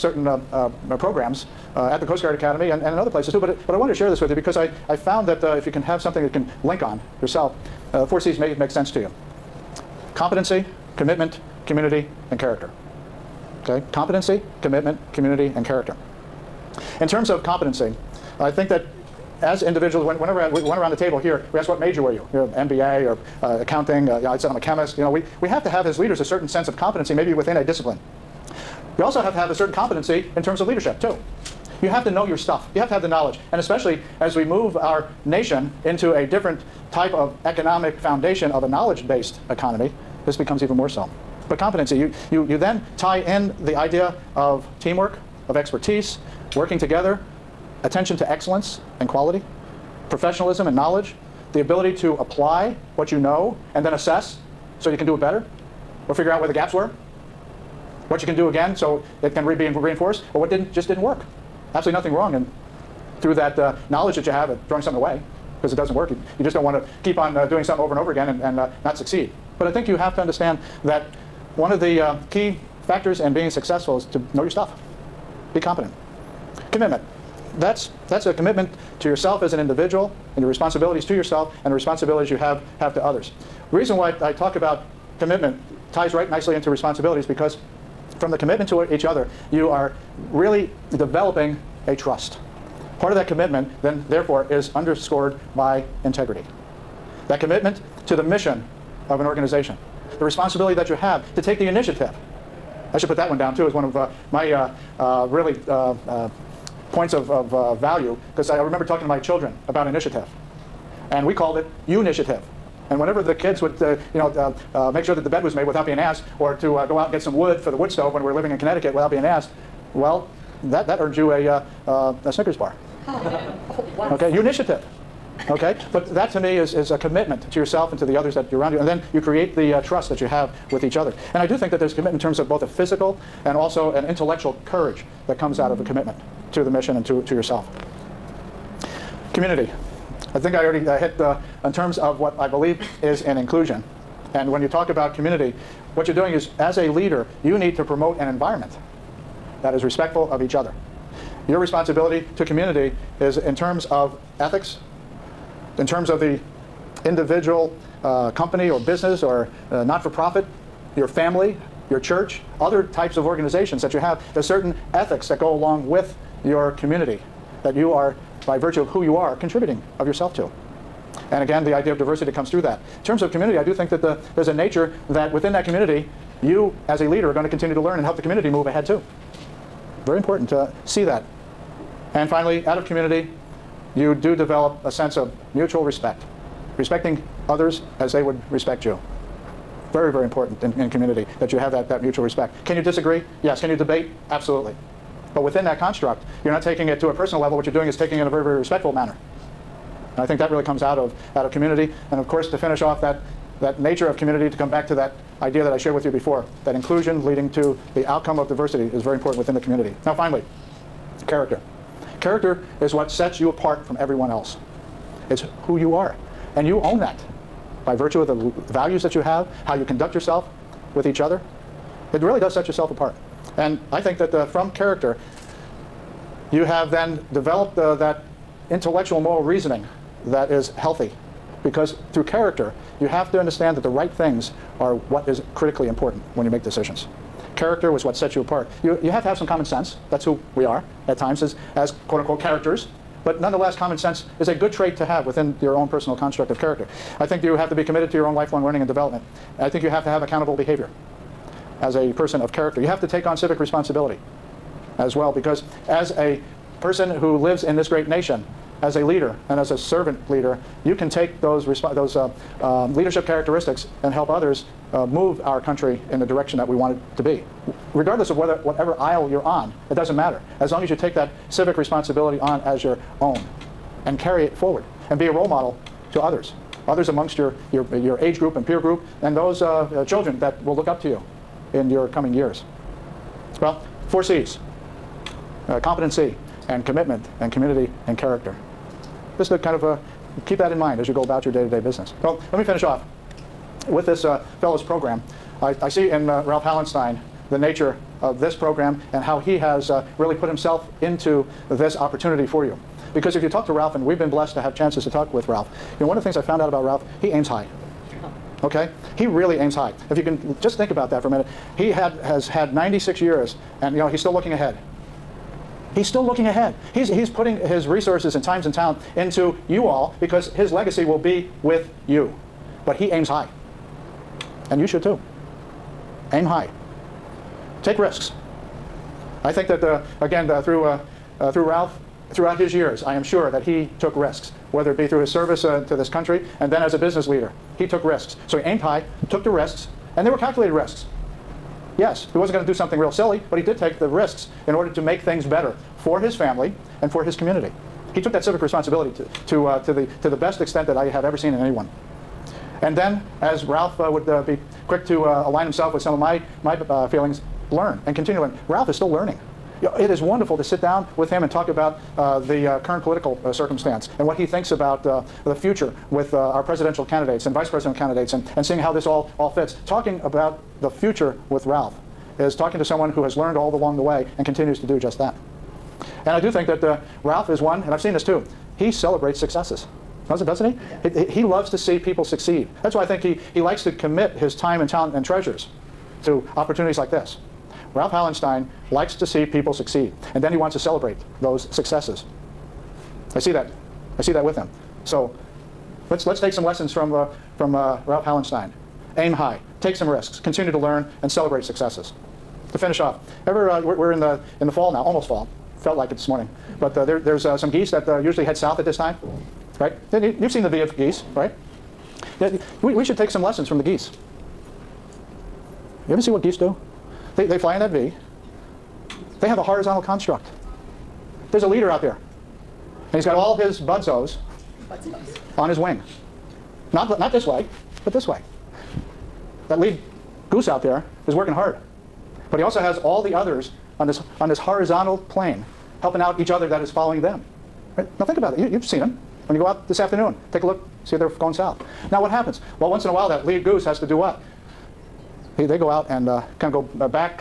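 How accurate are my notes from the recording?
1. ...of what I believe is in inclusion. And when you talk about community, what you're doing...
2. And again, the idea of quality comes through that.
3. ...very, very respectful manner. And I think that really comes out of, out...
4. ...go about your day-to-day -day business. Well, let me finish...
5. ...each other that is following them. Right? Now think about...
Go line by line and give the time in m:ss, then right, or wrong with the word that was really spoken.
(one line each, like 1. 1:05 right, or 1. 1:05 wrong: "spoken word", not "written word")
1. 2:21 right
2. 2:51 wrong: "diversity", not "quality"
3. 3:18 right
4. 4:51 right
5. 7:16 right.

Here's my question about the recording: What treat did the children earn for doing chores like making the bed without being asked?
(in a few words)
A Snickers bar.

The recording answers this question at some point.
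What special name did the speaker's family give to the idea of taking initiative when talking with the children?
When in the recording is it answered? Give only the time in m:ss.
1:51.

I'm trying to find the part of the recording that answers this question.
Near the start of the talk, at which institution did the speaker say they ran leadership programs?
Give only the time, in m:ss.
0:02.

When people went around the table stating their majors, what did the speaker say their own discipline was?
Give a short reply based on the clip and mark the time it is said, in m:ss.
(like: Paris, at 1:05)
Chemist, at 0:24.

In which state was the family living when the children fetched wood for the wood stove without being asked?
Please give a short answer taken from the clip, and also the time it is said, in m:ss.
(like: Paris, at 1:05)
Connecticut, at 1:58.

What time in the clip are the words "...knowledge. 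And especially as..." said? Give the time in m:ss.
0:33.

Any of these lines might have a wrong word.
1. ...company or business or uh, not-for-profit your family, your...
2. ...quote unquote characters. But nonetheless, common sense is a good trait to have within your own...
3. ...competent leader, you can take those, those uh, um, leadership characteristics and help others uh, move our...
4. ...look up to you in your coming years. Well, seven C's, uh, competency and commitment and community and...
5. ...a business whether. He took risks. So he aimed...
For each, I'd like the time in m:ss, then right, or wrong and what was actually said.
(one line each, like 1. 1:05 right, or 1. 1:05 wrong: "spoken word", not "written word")
1. 2:38 right
2. 4:02 right
3. 4:19 wrong: "servant", not "competent"
4. 4:40 wrong: "four", not "seven"
5. 5:36 wrong: "leader", not "whether".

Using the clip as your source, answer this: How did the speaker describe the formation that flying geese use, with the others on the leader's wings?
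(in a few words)
A horizontal construct.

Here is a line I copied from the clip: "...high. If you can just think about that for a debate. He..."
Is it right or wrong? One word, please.
wrong.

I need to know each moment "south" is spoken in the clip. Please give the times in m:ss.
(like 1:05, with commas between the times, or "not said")
6:48, 7:21.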